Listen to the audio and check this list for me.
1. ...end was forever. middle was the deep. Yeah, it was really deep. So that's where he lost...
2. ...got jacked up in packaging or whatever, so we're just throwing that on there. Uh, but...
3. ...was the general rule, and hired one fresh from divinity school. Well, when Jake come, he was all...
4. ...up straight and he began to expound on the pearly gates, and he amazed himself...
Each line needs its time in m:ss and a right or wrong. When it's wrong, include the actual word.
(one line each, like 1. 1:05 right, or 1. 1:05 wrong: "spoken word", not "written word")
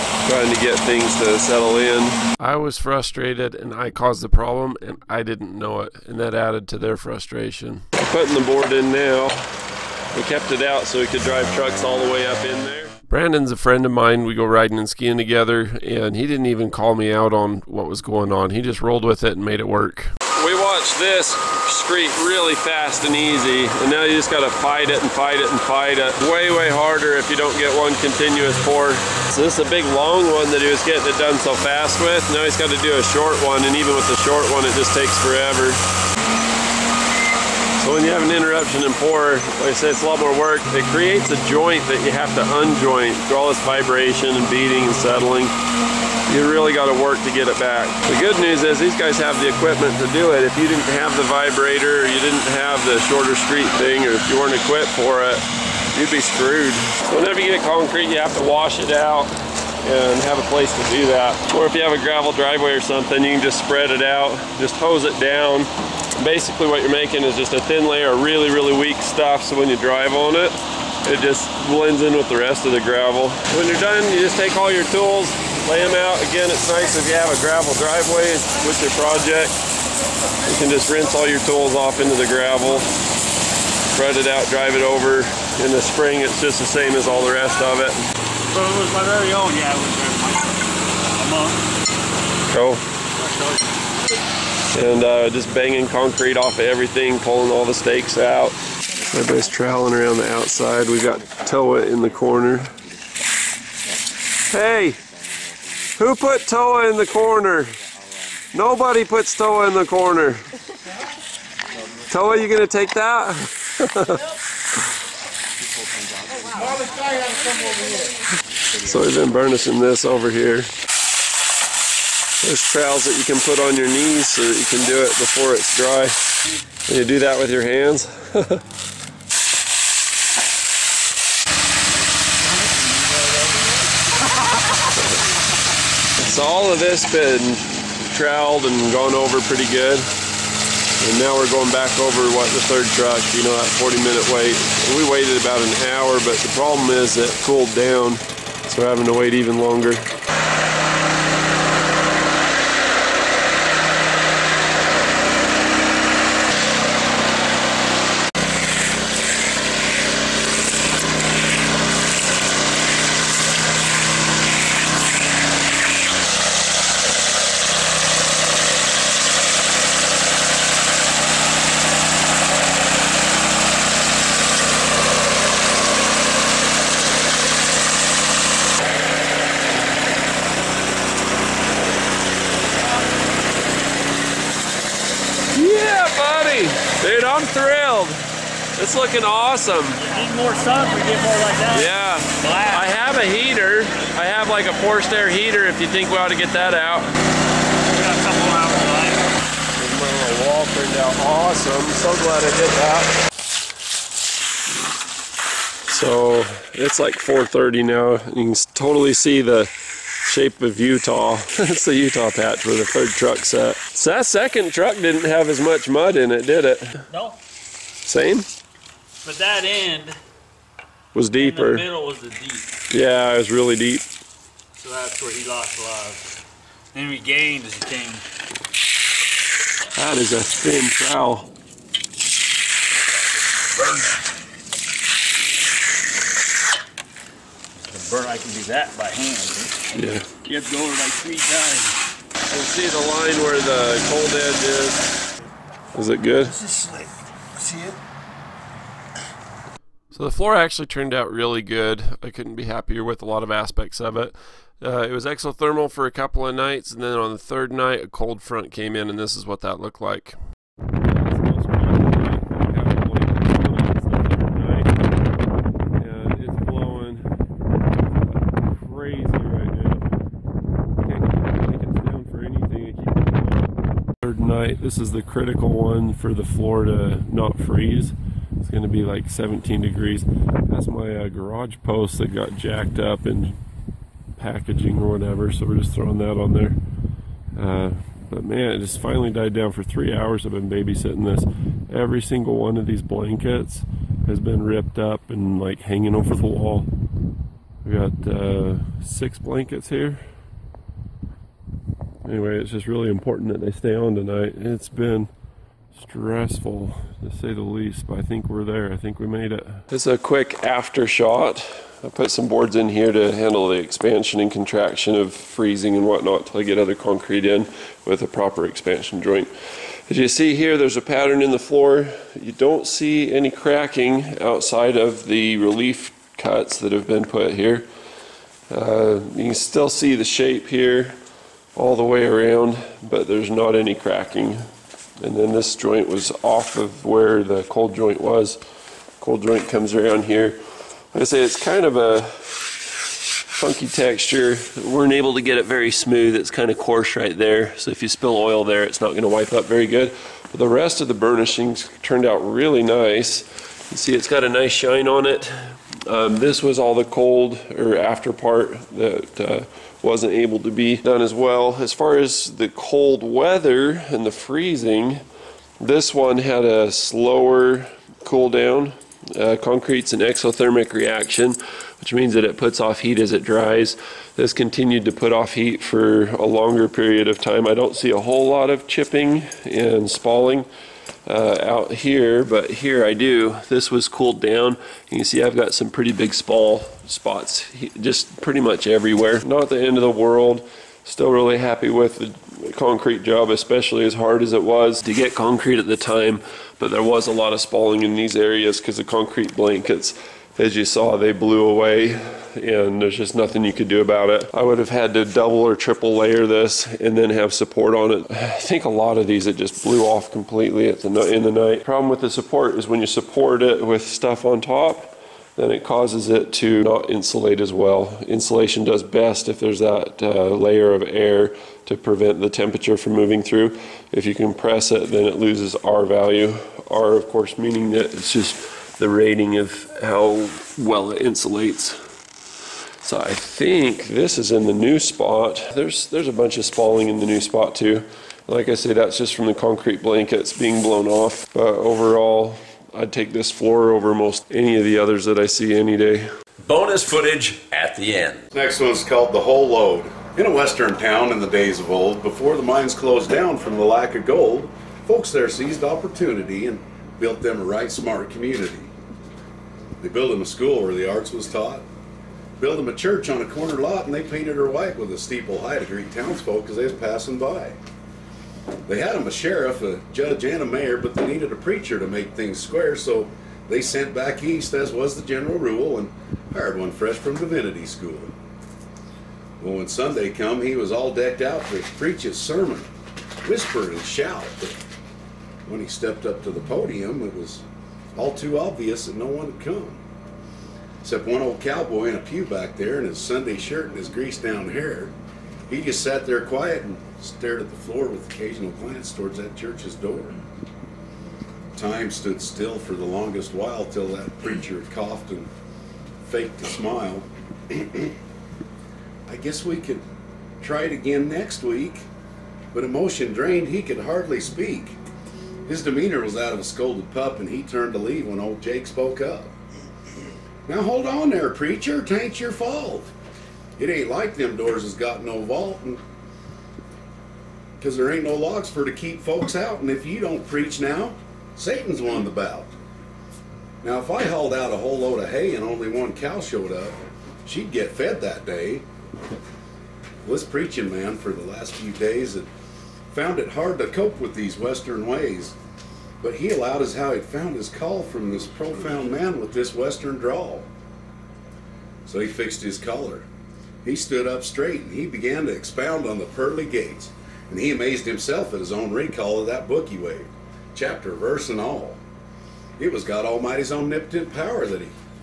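1. 3:39 wrong: "deeper", not "forever"
2. 4:42 right
3. 7:54 wrong: "Sunday", not "Jake"
4. 9:14 right.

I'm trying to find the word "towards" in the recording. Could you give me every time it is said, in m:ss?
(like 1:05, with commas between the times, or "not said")
8:19.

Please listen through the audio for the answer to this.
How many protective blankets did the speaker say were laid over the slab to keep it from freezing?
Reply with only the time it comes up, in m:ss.
4:59.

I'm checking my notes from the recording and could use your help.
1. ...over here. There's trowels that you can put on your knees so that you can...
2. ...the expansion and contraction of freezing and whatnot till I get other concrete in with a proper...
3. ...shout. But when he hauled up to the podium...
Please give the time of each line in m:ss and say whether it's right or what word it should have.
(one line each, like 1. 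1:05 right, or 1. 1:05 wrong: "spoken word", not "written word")
1. 2:00 right
2. 5:13 right
3. 8:04 wrong: "stepped", not "hauled".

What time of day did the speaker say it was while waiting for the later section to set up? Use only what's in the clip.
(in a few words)
4:30.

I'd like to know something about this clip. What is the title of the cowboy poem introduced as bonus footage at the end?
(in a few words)
The Whole Load.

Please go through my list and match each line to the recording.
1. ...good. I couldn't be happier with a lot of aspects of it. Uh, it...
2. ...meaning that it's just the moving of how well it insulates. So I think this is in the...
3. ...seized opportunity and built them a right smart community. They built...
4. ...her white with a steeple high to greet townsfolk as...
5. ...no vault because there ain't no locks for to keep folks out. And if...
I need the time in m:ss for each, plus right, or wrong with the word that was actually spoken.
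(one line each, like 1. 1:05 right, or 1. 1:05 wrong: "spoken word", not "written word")
1. 4:11 right
2. 7:07 wrong: "rating", not "moving"
3. 7:35 right
4. 7:44 right
5. 8:45 right.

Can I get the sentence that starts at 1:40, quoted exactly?
We've got Toa in the corner.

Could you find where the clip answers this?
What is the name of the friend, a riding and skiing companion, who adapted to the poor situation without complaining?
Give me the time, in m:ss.
0:13.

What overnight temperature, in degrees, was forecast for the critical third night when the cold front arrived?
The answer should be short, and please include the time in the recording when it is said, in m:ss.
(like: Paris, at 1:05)
17, at 4:39.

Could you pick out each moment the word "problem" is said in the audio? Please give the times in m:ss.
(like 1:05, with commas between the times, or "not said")
0:04, 2:26, 6:51.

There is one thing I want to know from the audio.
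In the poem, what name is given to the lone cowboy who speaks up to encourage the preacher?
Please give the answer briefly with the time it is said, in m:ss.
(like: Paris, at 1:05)
Jake, at 8:38.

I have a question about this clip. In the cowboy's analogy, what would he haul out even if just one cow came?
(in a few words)
A whole load of hay.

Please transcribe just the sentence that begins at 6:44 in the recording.
I would have had to double or triple layer this and then have support on it.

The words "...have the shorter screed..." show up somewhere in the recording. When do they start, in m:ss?
0:52.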